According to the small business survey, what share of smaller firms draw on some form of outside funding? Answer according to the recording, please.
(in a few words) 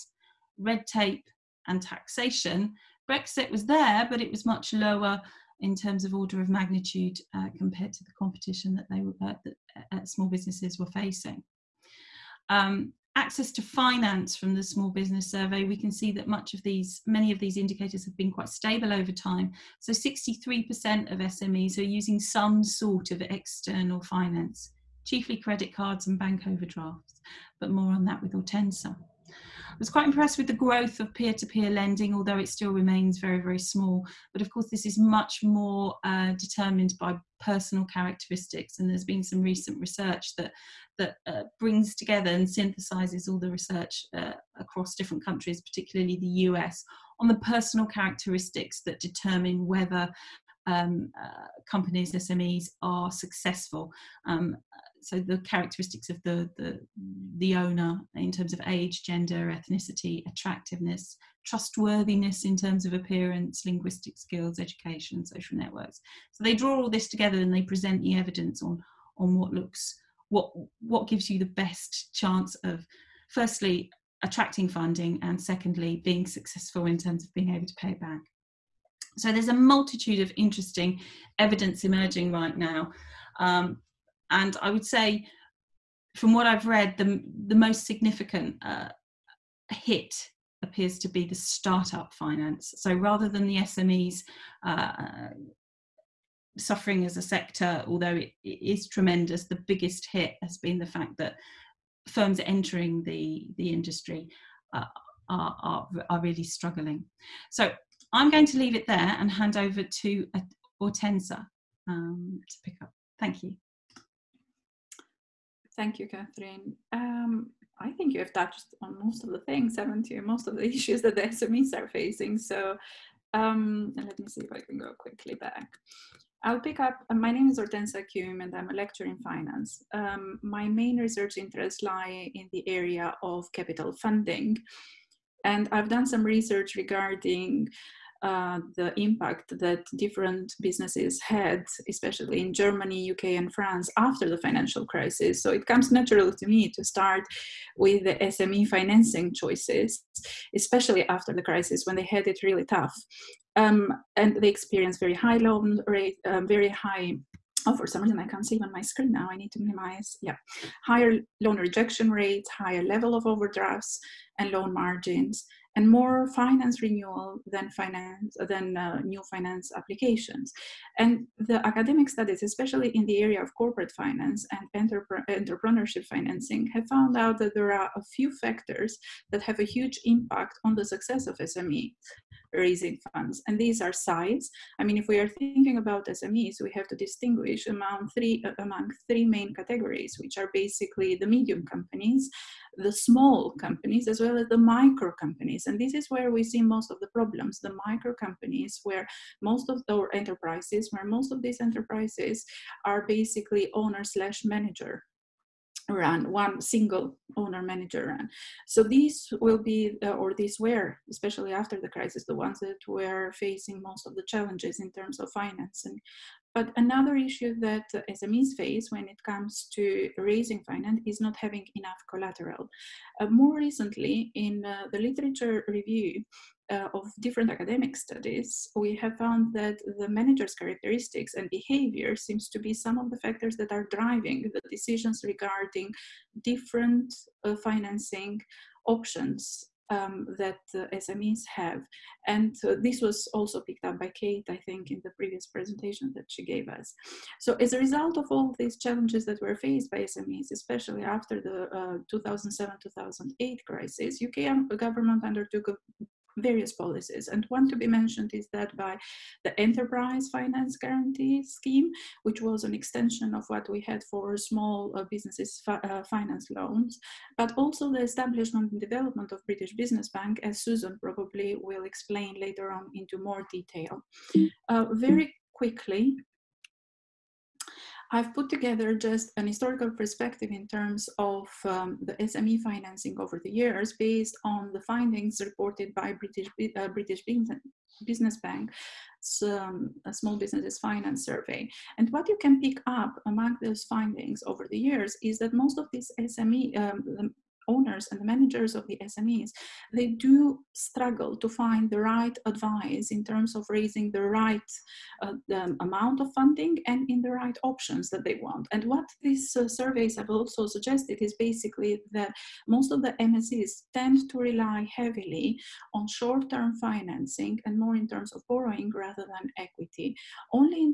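63%.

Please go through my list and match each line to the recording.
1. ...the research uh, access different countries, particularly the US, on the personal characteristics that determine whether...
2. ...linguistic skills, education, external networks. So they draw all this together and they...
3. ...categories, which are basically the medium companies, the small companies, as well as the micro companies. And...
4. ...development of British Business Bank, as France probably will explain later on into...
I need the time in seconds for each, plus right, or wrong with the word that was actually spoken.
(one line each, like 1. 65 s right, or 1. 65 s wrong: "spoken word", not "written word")
1. 43 s wrong: "across", not "access"
2. 63 s wrong: "social", not "external"
3. 189 s right
4. 268 s wrong: "Susan", not "France".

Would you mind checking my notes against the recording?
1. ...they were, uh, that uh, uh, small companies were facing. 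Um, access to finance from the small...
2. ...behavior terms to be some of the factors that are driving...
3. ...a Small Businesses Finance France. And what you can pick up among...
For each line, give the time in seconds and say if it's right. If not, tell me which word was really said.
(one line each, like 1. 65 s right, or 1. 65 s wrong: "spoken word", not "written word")
1. 8 s wrong: "businesses", not "companies"
2. 231 s wrong: "seems", not "terms"
3. 290 s wrong: "Survey", not "France".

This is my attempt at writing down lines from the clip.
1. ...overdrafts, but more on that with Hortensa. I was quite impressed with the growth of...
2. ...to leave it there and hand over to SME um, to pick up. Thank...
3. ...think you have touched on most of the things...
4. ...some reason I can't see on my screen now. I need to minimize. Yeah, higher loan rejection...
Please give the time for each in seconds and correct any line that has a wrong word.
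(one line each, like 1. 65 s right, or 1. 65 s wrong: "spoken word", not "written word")
1. 26 s right
2. 108 s wrong: "Hortensa", not "SME"
3. 117 s right
4. 157 s right.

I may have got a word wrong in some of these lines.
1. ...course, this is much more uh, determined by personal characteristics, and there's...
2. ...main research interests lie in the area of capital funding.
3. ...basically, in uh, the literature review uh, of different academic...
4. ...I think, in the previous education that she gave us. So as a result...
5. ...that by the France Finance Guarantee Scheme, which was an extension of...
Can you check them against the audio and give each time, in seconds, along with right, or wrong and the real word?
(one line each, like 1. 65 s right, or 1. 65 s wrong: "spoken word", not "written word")
1. 34 s right
2. 130 s right
3. 223 s wrong: "recently", not "basically"
4. 244 s wrong: "presentation", not "education"
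5. 258 s wrong: "Enterprise", not "France".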